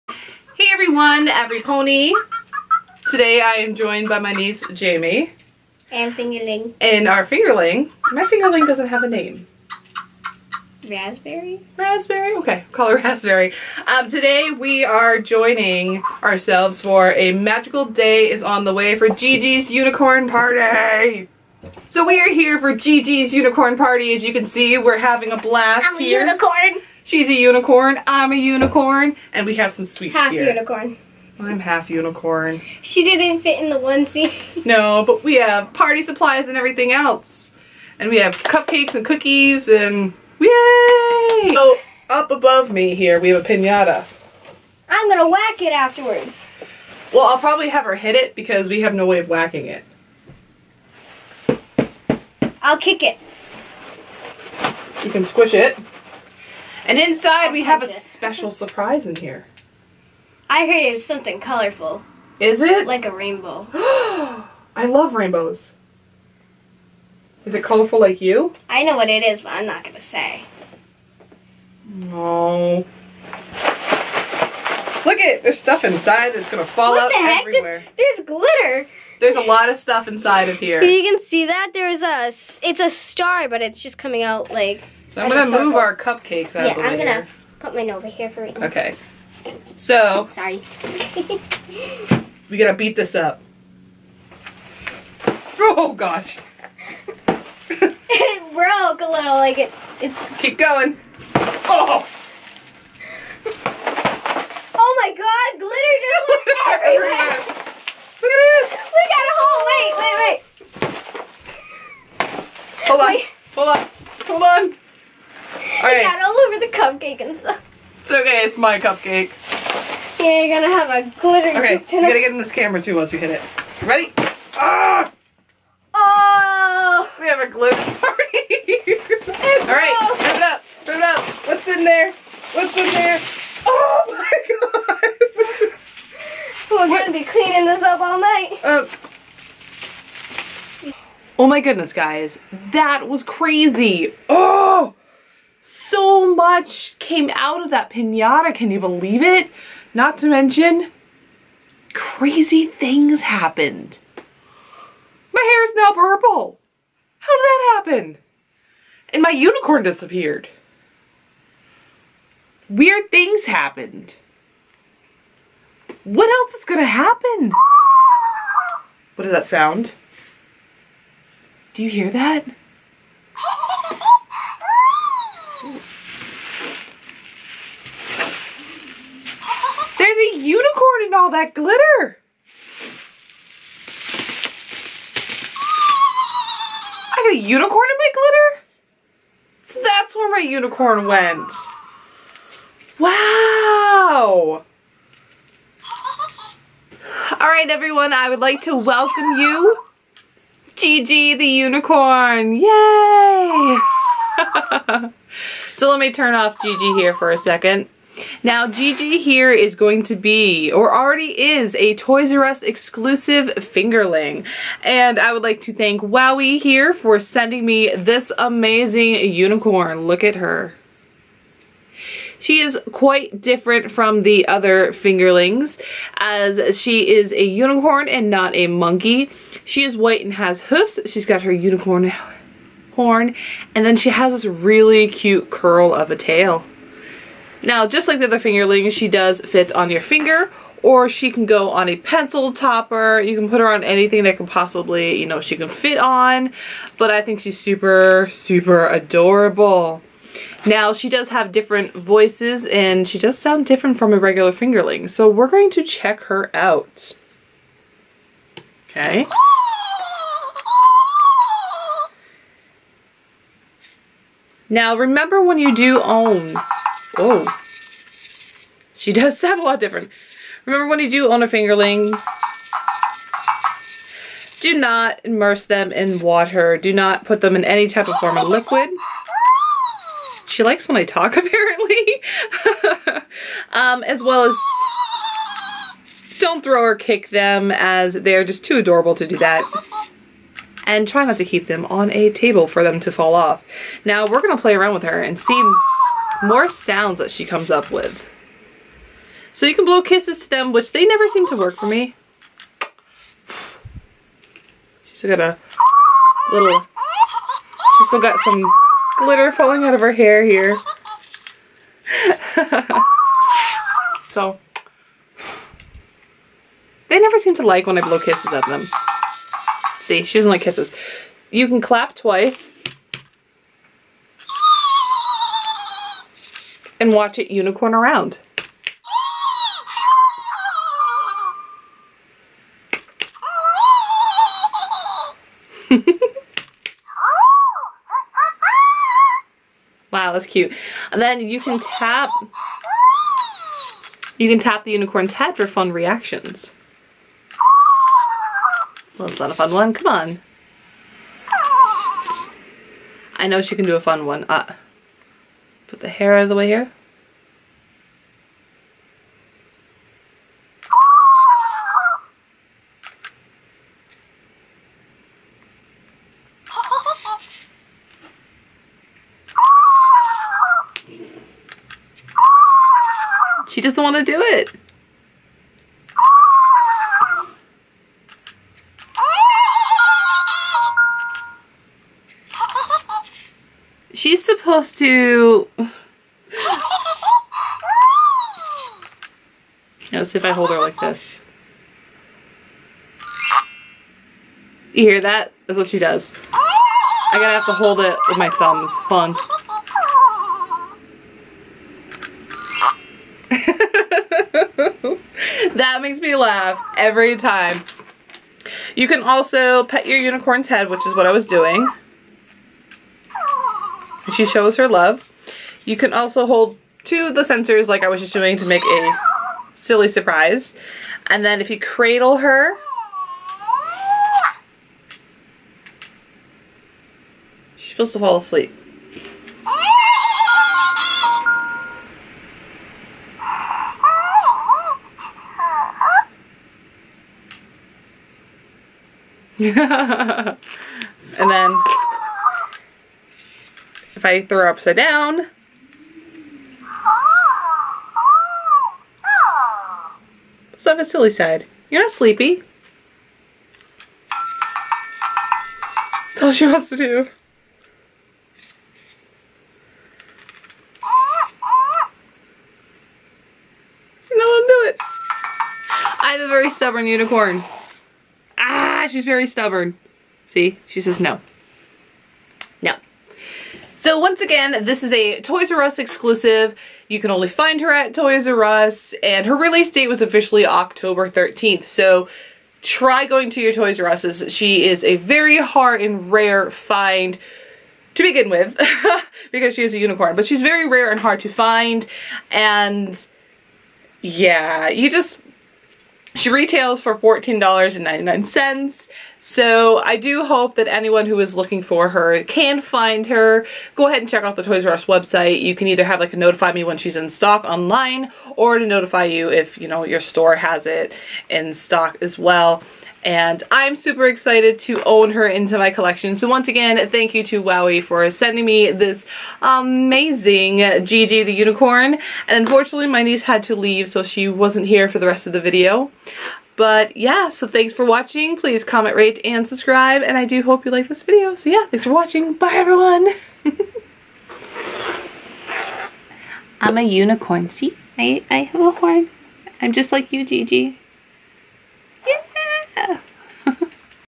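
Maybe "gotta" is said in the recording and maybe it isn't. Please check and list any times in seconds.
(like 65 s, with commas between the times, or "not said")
122 s, 397 s.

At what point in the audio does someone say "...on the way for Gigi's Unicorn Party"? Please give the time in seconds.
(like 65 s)
18 s.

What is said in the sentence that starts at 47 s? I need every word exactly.
Well, I'll probably have her hit it because we have no way of whacking it.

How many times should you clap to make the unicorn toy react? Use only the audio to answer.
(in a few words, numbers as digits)
2.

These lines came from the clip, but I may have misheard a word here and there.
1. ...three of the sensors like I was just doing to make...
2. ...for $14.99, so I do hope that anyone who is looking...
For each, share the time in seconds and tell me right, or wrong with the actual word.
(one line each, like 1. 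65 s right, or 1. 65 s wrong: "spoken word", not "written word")
1. 417 s wrong: "two", not "three"
2. 497 s right.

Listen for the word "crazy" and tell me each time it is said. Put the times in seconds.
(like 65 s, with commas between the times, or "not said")
143 s, 151 s.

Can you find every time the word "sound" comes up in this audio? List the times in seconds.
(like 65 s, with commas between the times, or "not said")
169 s, 253 s, 269 s, 296 s.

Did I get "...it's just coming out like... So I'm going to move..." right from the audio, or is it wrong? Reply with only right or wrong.
right.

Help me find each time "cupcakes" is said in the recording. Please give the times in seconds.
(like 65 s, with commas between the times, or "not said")
38 s, 85 s, 118 s.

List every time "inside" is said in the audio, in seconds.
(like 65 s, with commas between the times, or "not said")
56 s, 75 s, 80 s.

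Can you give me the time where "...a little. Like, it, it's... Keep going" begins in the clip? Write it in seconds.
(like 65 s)
99 s.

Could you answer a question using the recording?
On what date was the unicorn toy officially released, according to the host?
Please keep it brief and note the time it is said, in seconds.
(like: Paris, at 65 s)
October 13th, at 480 s.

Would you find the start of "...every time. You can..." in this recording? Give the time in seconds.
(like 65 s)
406 s.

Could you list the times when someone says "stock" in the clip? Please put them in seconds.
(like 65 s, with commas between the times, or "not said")
507 s, 511 s.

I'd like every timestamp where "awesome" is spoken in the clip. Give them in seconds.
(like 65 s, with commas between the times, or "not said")
not said.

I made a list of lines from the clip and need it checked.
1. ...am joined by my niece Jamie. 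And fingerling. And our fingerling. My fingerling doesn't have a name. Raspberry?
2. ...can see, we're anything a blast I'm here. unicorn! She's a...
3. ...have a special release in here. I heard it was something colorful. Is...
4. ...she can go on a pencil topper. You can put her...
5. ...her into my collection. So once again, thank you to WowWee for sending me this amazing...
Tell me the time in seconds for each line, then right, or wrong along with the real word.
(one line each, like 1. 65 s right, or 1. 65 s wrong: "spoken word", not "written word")
1. 3 s right
2. 24 s wrong: "having", not "anything"
3. 57 s wrong: "surprise", not "release"
4. 241 s right
5. 515 s right.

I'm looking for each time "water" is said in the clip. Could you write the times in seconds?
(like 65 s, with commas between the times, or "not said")
276 s.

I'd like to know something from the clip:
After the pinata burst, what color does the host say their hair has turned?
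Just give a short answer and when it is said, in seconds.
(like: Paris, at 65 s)
Purple, at 155 s.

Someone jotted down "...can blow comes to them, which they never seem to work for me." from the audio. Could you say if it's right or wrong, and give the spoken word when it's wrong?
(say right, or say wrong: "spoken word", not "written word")
wrong: "kisses", not "comes".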